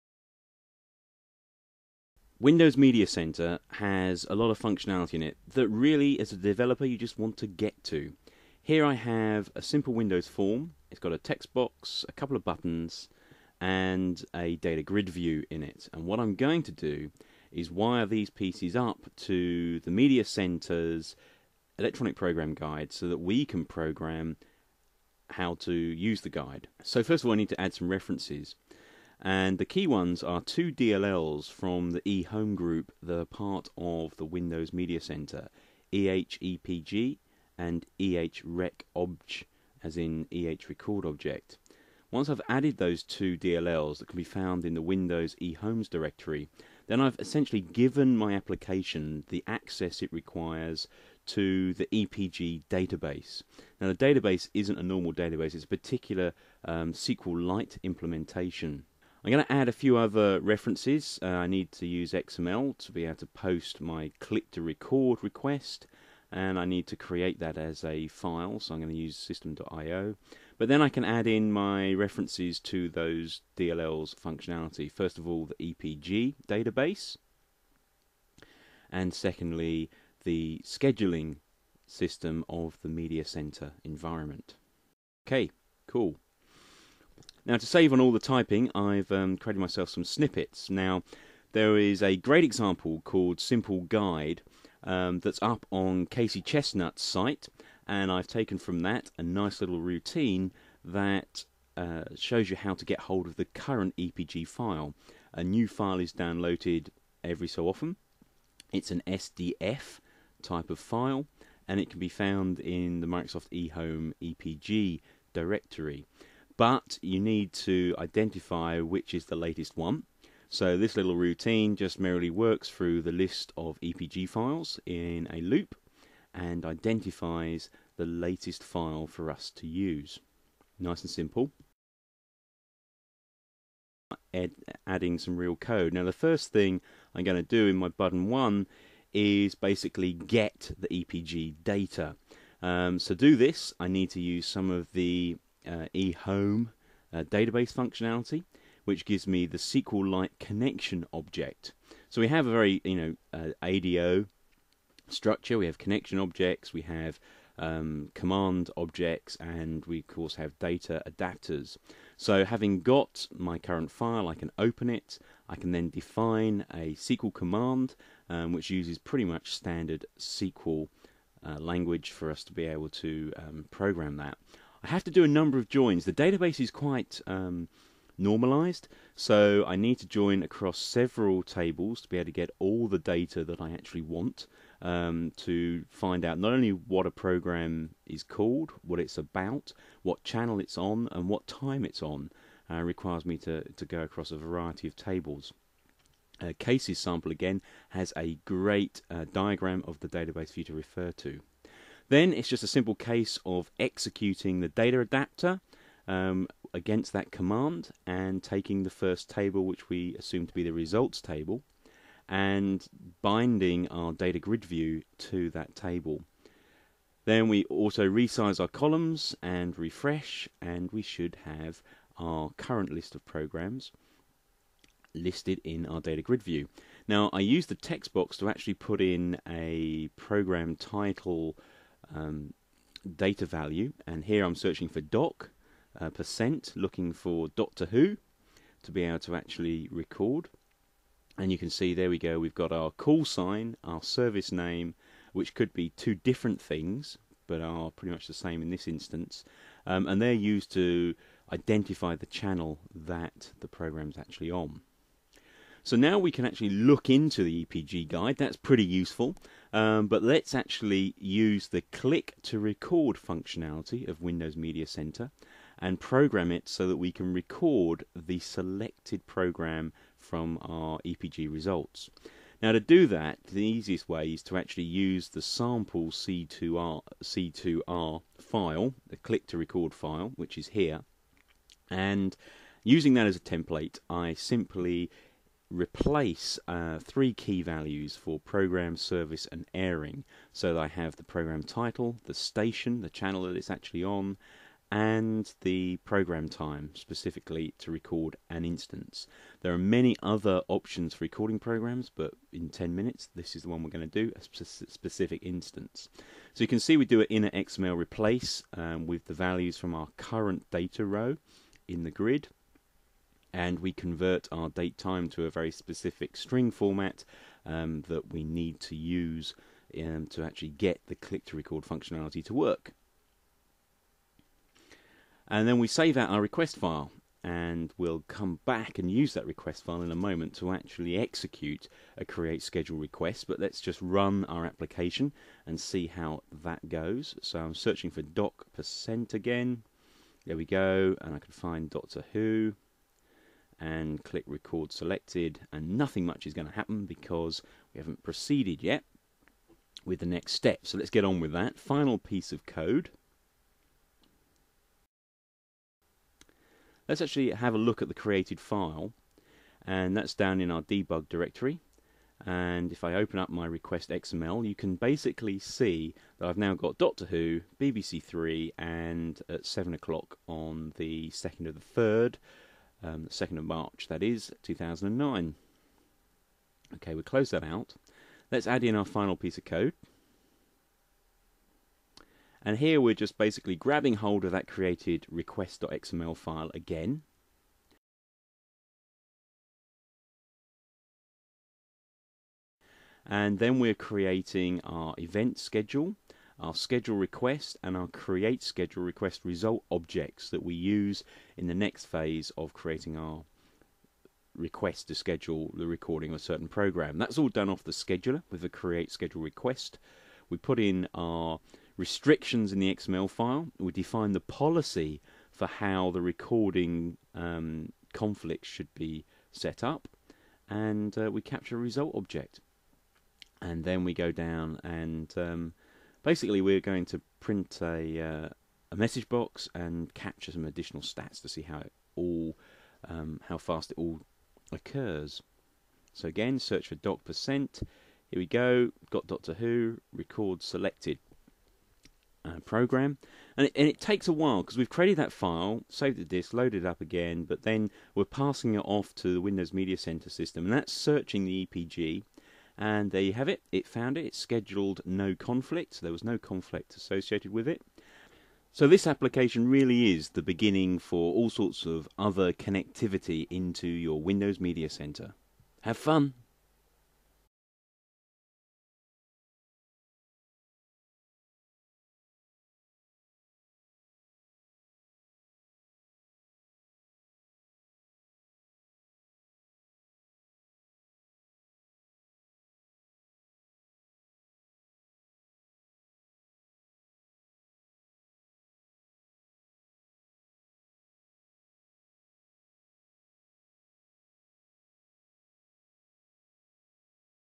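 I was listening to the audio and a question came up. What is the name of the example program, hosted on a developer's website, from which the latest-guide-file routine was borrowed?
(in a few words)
Simple Guide.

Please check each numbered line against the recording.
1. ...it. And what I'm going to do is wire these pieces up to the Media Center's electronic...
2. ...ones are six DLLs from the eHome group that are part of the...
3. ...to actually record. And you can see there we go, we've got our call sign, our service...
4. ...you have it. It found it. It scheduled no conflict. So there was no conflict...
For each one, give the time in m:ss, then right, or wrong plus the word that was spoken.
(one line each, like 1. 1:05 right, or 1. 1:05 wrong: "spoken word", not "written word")
1. 0:15 right
2. 0:29 wrong: "two", not "six"
3. 3:59 right
4. 7:33 right.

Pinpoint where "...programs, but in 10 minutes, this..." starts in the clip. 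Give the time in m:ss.
5:01.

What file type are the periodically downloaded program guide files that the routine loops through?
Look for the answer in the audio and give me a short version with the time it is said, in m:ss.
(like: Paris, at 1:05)
SDF, at 1:49.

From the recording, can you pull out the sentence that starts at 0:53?
Now, the database isn't a normal database, it's a particular um, SQLite implementation.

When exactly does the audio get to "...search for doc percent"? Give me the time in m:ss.
7:16.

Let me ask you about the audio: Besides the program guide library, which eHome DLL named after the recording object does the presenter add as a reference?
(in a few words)
EHRecObj.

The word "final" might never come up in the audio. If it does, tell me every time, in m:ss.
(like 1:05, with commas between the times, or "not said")
5:51, 6:19.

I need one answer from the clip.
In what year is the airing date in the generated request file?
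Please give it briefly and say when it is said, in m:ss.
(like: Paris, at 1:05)
2009, at 6:14.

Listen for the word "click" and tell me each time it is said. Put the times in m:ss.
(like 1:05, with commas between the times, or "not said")
1:04, 4:21, 4:39, 5:21, 5:44.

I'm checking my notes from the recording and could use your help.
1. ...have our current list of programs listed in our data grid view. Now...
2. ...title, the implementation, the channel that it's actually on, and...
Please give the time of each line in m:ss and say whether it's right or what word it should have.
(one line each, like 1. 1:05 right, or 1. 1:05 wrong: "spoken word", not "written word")
1. 3:41 right
2. 4:51 wrong: "station", not "implementation".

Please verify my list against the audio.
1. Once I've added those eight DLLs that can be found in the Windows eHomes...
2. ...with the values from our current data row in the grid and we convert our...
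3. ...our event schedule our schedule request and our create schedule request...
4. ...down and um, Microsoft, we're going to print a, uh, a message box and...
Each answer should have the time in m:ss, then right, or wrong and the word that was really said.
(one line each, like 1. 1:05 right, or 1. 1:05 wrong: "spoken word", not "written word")
1. 0:42 wrong: "two", not "eight"
2. 5:09 right
3. 6:34 right
4. 7:04 wrong: "Basically", not "Microsoft".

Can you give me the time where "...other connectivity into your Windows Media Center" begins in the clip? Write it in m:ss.
7:42.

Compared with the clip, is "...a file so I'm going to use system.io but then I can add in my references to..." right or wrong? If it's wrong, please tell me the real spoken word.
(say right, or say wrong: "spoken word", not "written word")
right.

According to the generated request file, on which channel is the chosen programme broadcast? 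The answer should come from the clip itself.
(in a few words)
BBC Three.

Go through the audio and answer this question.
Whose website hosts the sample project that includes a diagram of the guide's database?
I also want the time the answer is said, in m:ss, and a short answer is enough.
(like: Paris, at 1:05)
Casey Chestnut, at 1:36.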